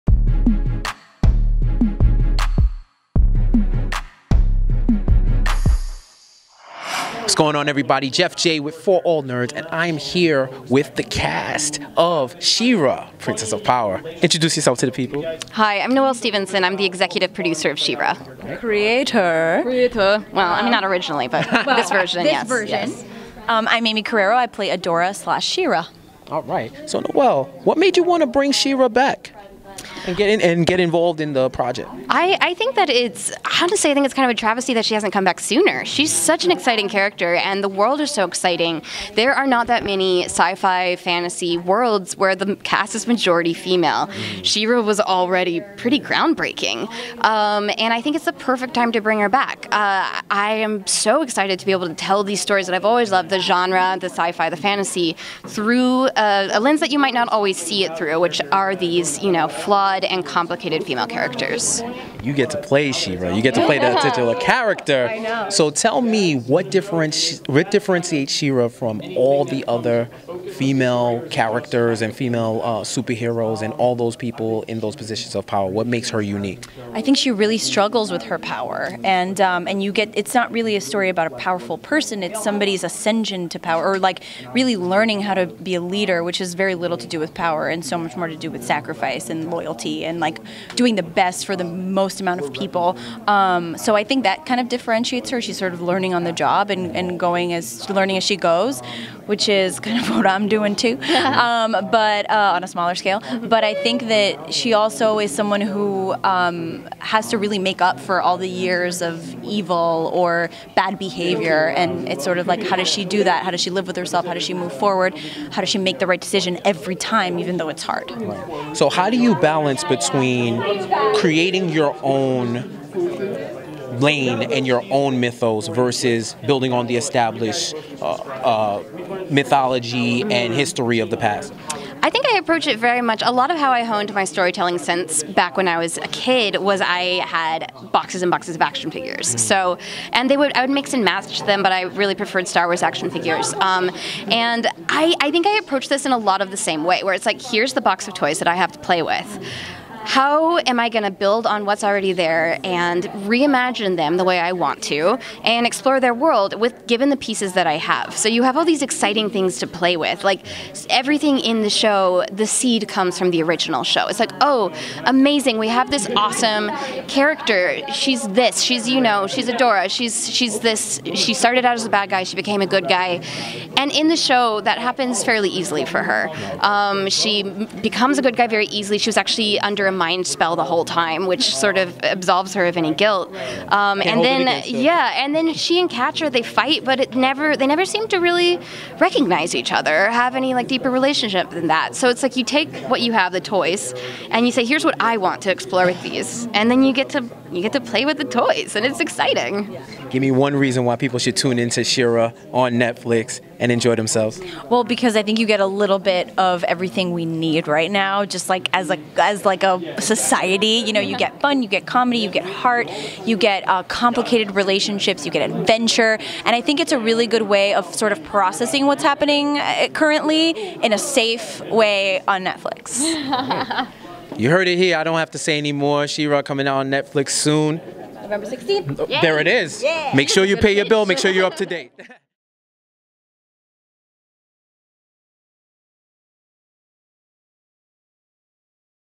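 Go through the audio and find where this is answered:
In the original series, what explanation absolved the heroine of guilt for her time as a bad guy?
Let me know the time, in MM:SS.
03:00.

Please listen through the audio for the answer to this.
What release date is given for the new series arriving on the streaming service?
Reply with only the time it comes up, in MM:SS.
03:48.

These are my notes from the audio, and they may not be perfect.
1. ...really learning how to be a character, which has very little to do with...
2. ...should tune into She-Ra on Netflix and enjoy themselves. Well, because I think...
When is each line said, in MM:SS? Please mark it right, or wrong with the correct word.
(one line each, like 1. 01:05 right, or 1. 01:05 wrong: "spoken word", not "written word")
1. 01:24 wrong: "leader", not "character"
2. 03:21 right.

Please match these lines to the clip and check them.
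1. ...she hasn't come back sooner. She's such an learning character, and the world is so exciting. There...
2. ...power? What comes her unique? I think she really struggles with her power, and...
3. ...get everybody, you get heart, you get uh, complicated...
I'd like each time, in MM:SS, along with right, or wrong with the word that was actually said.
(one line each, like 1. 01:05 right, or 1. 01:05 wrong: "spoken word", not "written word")
1. 00:34 wrong: "exciting", not "learning"
2. 01:15 wrong: "makes", not "comes"
3. 03:31 wrong: "comedy", not "everybody".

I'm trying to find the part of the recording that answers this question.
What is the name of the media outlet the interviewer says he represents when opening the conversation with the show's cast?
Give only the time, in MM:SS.
00:08.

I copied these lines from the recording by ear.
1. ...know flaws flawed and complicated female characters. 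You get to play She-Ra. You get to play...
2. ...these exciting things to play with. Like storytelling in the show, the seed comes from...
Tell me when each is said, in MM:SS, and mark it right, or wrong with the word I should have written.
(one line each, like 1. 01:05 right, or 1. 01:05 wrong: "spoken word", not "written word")
1. 00:59 right
2. 02:38 wrong: "everything", not "storytelling".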